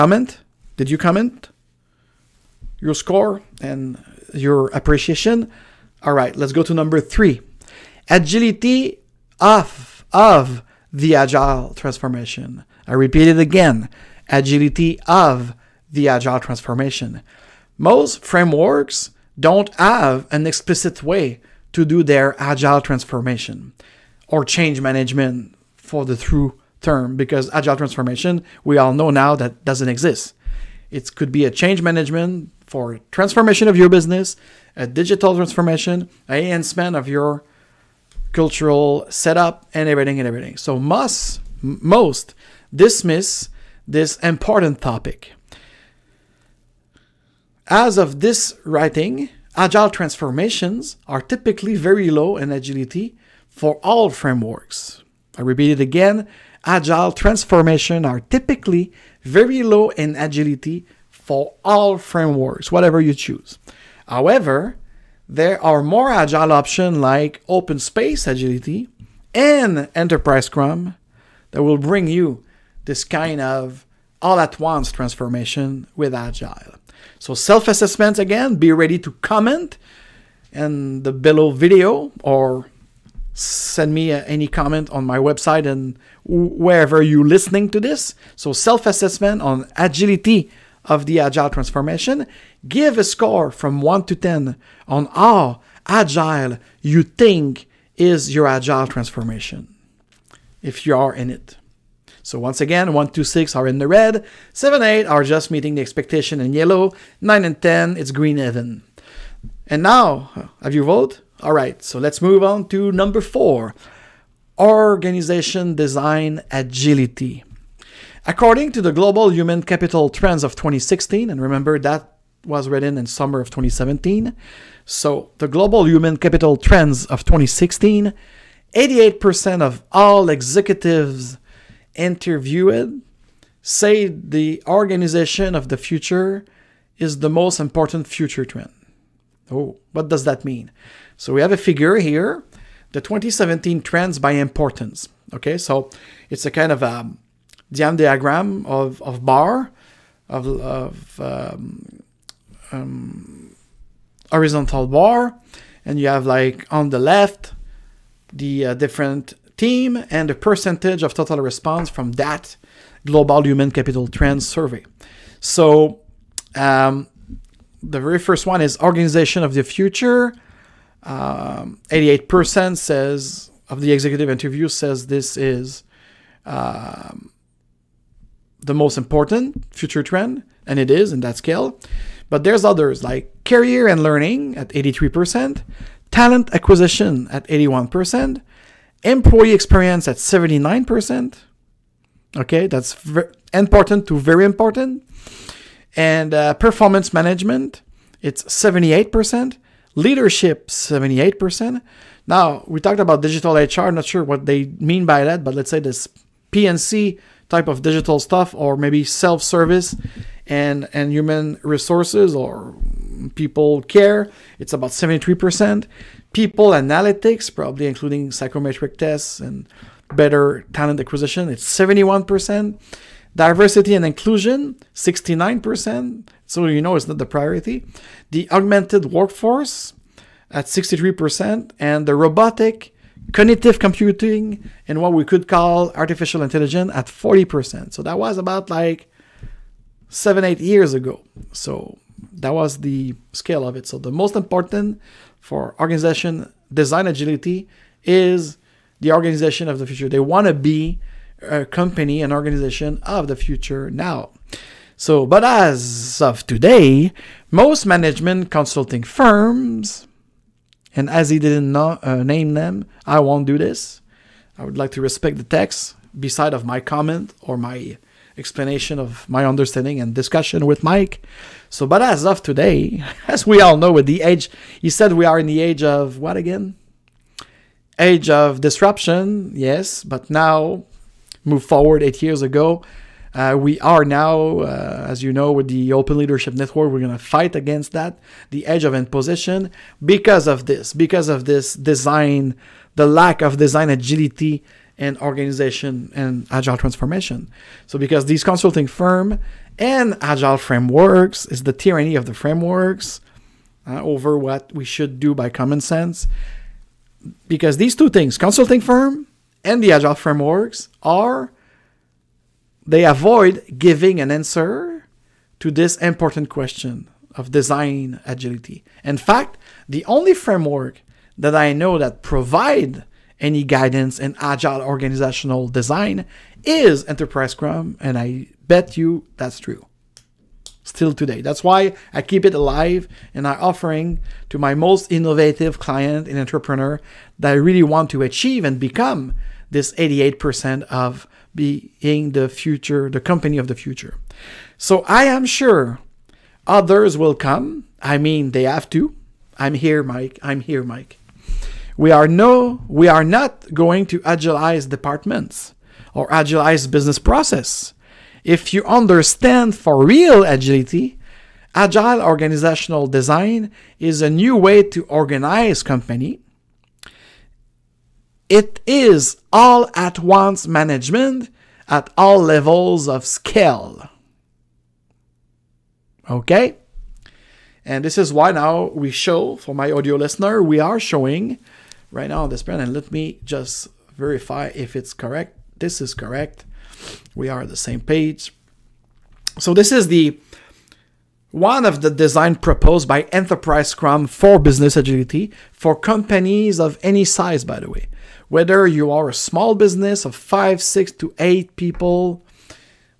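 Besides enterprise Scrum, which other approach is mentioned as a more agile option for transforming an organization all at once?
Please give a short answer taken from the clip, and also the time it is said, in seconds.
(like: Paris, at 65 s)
Open space agility, at 67 s.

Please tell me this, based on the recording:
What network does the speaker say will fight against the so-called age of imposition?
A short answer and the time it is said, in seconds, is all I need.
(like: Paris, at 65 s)
Open Leadership Network, at 285 s.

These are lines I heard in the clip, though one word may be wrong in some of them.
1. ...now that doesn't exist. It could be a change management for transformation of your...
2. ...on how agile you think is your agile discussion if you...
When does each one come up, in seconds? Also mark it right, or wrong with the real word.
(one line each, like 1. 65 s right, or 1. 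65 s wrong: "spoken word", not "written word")
1. 29 s right
2. 94 s wrong: "transformation", not "discussion".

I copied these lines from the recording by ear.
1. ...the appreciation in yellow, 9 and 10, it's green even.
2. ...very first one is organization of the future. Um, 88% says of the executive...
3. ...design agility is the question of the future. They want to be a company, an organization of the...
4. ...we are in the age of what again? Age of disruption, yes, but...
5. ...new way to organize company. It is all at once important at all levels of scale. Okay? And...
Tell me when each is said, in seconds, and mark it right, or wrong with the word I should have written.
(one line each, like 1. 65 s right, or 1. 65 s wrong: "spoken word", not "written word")
1. 105 s wrong: "expectation", not "appreciation"
2. 168 s right
3. 246 s wrong: "organization", not "question"
4. 275 s right
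5. 364 s wrong: "management", not "important".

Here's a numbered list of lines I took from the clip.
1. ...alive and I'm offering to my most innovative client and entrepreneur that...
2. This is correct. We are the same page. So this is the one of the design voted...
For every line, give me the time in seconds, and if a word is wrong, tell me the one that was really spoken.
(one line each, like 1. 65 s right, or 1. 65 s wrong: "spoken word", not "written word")
1. 332 s right
2. 385 s wrong: "proposed", not "voted".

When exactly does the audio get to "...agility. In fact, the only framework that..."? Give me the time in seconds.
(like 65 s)
318 s.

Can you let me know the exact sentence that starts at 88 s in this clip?
So self assessment on agility of the agile transformation.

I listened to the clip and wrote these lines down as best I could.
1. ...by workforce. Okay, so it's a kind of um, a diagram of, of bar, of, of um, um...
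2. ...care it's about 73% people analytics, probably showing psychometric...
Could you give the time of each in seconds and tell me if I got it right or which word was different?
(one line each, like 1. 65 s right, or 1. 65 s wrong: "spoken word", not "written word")
1. 144 s wrong: "importance", not "workforce"
2. 213 s wrong: "including", not "showing".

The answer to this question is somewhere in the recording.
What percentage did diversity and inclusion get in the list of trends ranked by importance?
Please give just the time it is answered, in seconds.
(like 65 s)
224 s.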